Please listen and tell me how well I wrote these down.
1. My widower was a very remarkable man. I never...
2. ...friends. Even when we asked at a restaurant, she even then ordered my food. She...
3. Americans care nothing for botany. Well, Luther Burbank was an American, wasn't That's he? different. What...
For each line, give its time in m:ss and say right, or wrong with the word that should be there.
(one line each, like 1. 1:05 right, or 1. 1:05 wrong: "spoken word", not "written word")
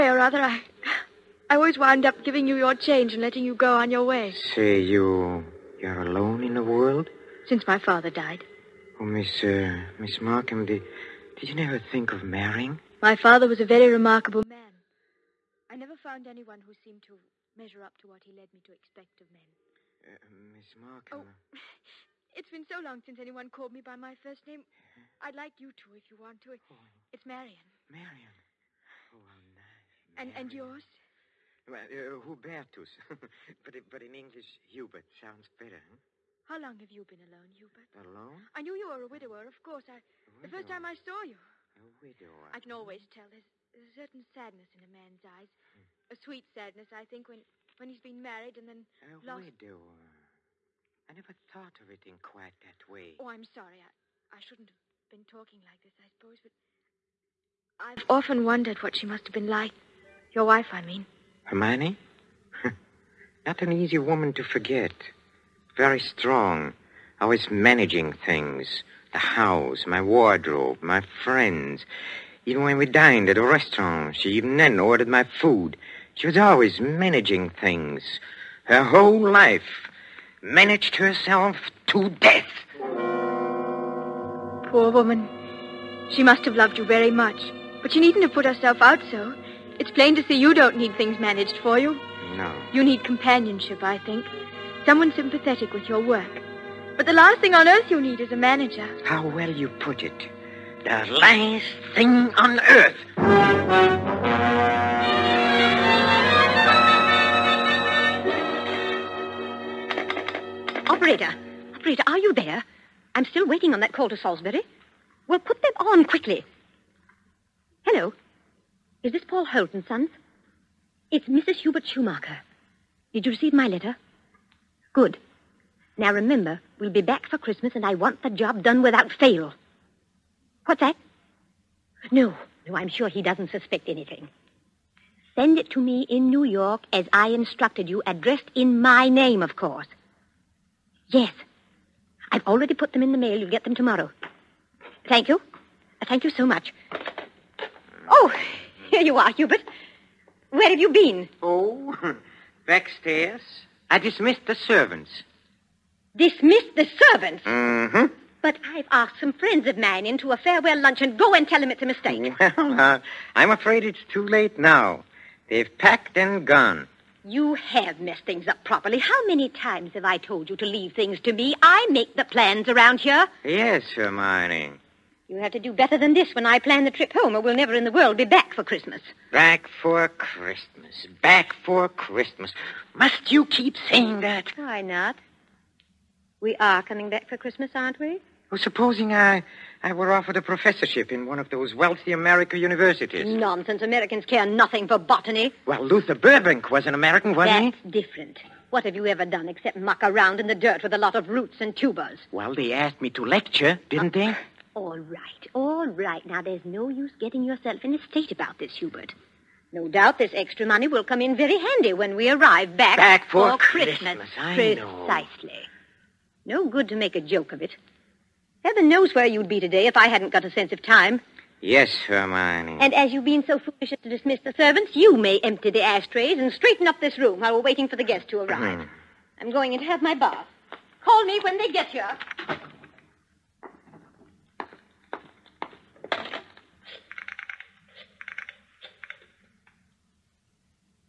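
1. 0:13 wrong: "father", not "widower"
2. 1:11 wrong: "dined", not "asked"
3. 3:13 right.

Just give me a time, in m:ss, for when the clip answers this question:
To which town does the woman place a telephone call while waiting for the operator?
1:54.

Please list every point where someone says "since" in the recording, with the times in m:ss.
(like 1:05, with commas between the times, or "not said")
0:07, 0:23.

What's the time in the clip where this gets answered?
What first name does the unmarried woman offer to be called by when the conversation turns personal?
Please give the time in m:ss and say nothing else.
0:26.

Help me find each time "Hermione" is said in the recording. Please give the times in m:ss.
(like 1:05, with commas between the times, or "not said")
1:01, 2:53, 3:42.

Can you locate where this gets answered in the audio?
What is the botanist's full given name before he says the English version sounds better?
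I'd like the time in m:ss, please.
0:32.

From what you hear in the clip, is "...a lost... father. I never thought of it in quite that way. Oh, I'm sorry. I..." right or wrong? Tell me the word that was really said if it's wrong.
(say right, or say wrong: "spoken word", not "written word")
wrong: "widower", not "father".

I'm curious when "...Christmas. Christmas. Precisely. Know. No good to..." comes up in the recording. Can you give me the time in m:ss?
3:33.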